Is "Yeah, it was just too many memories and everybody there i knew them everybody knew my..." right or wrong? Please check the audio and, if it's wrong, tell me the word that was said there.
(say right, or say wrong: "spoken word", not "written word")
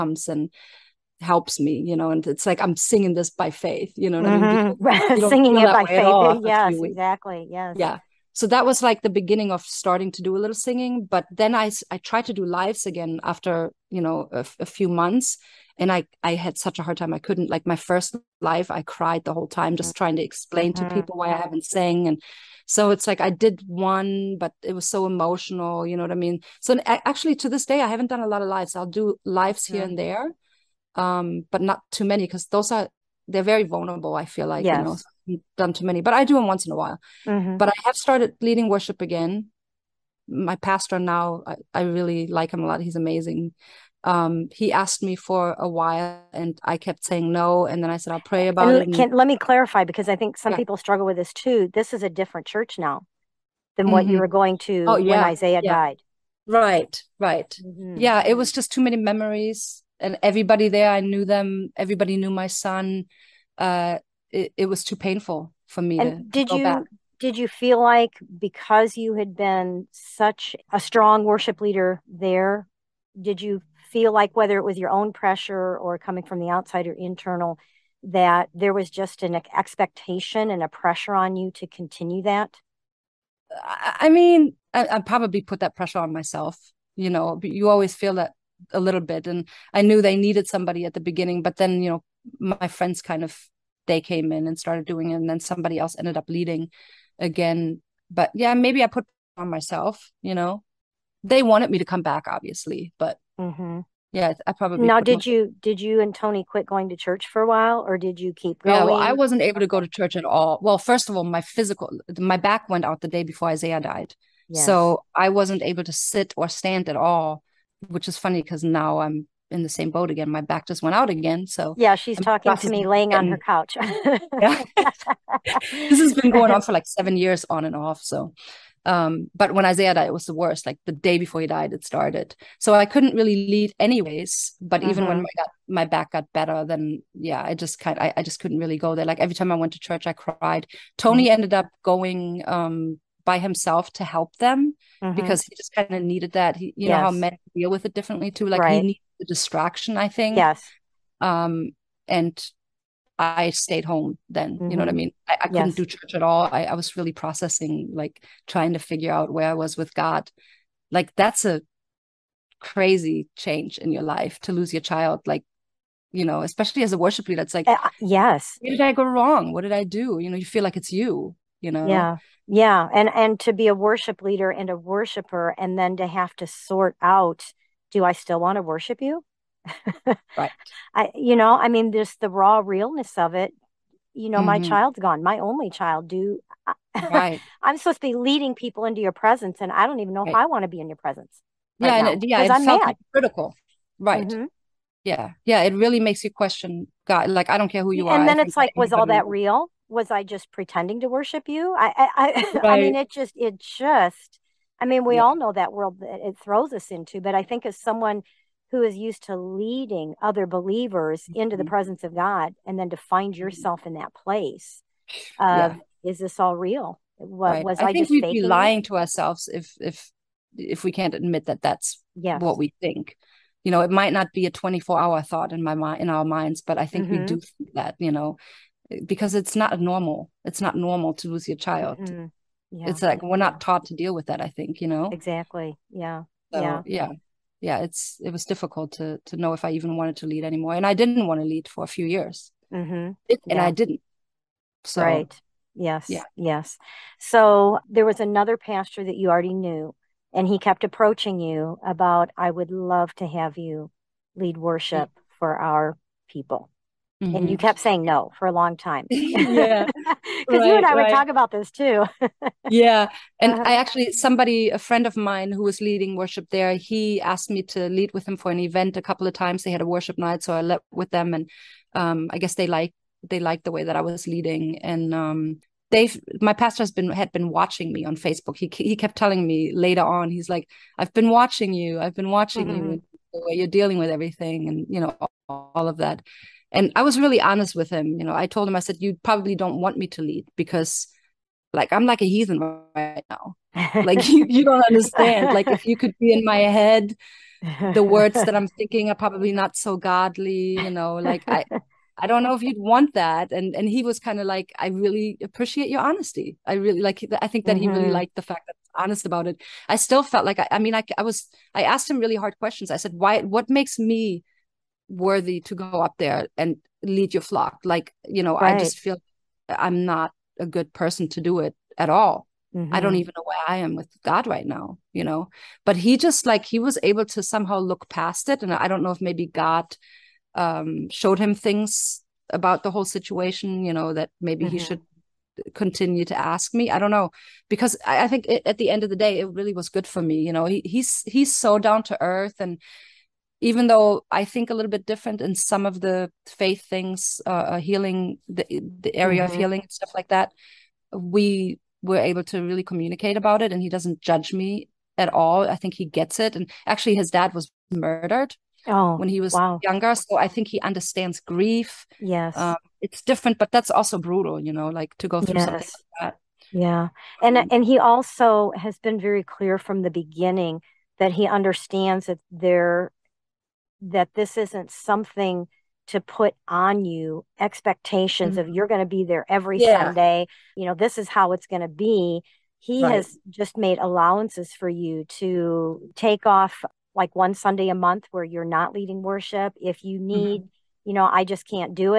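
right.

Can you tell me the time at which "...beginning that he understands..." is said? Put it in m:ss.
6:10.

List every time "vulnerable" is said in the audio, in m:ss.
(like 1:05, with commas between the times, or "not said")
0:33.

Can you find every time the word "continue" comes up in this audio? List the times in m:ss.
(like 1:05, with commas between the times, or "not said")
1:21, 5:35.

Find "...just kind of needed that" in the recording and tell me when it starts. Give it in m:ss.
2:25.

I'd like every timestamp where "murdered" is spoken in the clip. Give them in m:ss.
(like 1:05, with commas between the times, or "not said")
5:57.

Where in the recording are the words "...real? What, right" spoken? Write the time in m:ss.
3:36.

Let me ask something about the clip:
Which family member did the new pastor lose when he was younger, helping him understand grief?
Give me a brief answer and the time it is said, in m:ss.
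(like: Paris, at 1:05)
His dad, at 5:57.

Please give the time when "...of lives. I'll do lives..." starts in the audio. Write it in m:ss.
0:28.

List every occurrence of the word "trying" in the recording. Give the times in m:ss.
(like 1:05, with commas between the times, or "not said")
0:19, 2:38.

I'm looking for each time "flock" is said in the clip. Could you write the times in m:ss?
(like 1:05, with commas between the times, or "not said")
5:17.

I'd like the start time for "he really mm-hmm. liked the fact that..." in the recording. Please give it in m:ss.
5:07.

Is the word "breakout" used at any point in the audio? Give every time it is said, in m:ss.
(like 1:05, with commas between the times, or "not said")
not said.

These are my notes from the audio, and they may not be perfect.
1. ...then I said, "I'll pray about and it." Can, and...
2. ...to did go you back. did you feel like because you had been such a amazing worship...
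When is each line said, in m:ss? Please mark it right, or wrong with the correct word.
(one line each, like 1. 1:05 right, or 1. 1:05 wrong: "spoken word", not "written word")
1. 0:47 right
2. 1:06 wrong: "strong", not "amazing".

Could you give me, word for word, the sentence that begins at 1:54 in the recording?
so i wasn't able to sit or stand at all which is funny because now I'm in the same boat again.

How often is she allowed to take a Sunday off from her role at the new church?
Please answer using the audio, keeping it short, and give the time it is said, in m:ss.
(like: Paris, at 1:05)
One Sunday a month, at 6:27.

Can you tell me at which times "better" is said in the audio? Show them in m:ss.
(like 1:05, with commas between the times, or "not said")
2:16.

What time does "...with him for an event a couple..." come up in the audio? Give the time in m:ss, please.
4:28.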